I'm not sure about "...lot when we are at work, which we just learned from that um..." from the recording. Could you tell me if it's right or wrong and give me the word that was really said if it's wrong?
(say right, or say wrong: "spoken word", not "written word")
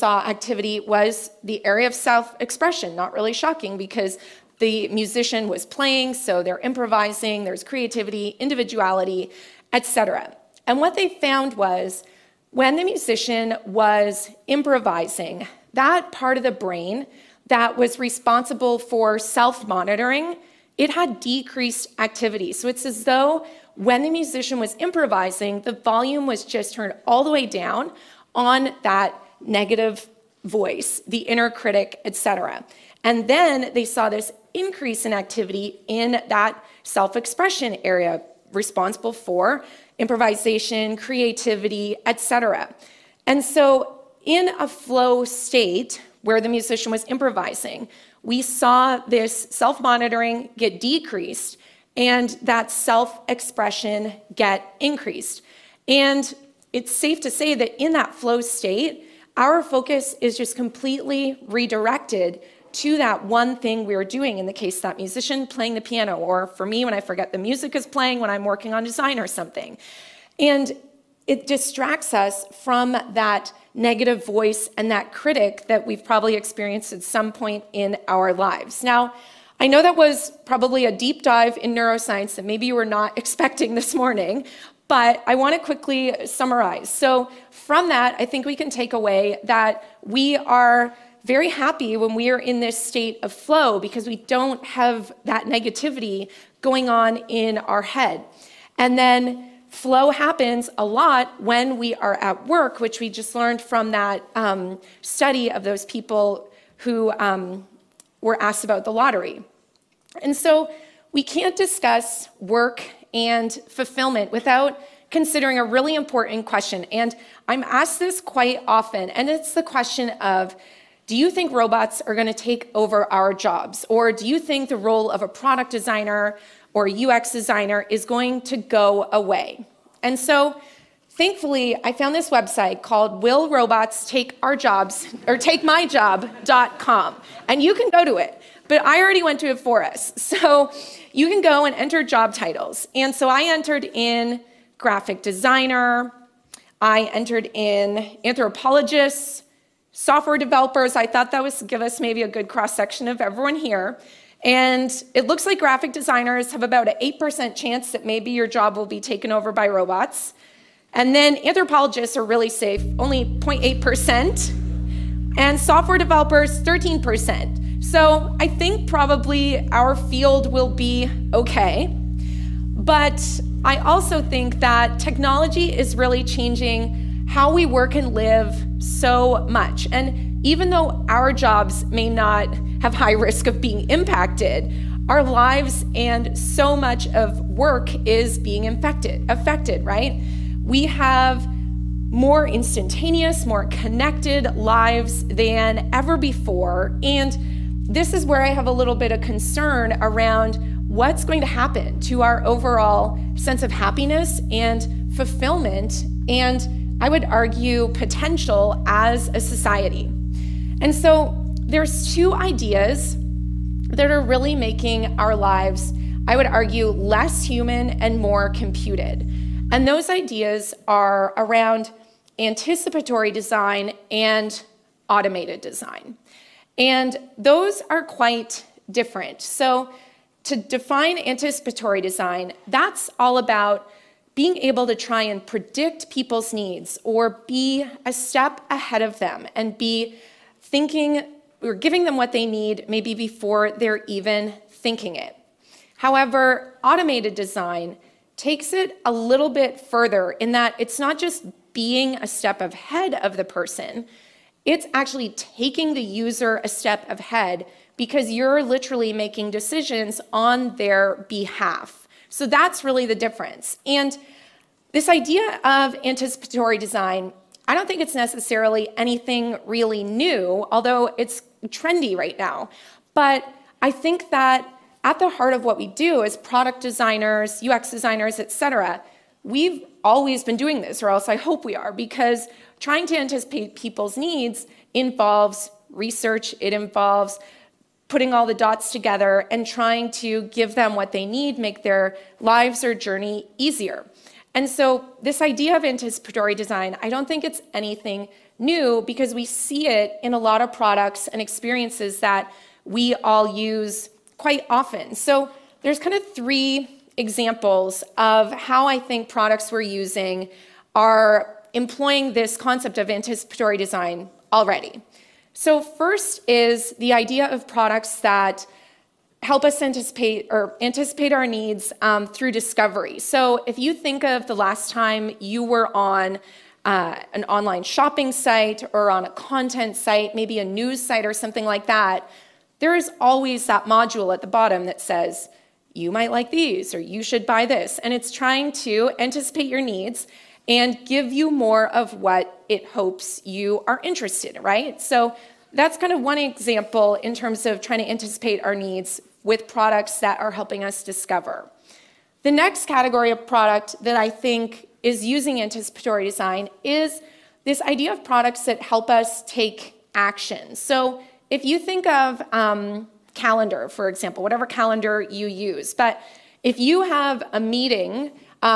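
right.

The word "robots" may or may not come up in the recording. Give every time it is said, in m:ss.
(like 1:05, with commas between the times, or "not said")
2:01, 2:13, 2:39.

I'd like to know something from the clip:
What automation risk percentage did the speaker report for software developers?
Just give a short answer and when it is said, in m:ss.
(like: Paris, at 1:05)
13%, at 2:46.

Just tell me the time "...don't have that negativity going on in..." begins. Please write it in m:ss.
1:34.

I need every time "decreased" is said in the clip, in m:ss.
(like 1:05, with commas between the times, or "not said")
0:21, 0:50.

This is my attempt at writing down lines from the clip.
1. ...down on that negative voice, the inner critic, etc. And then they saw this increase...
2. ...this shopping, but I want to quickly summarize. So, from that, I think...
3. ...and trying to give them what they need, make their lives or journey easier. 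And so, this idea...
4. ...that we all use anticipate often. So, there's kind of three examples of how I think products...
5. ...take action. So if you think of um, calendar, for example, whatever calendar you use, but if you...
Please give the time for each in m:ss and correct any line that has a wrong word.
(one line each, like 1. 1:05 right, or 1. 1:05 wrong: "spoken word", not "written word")
1. 0:27 right
2. 1:23 wrong: "morning", not "shopping"
3. 4:49 right
4. 5:02 wrong: "quite", not "anticipate"
5. 5:59 right.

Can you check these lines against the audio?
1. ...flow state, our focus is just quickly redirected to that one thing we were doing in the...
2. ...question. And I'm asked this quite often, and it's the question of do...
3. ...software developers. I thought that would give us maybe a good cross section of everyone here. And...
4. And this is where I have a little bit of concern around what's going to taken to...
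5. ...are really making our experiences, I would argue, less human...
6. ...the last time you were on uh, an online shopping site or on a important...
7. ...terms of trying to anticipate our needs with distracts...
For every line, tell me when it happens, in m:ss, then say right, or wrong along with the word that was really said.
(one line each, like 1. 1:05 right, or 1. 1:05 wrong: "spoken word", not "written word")
1. 0:58 wrong: "completely", not "quickly"
2. 1:56 right
3. 2:29 right
4. 3:17 wrong: "happen", not "taken"
5. 3:34 wrong: "lives", not "experiences"
6. 5:24 wrong: "content", not "important"
7. 5:47 wrong: "products", not "distracts".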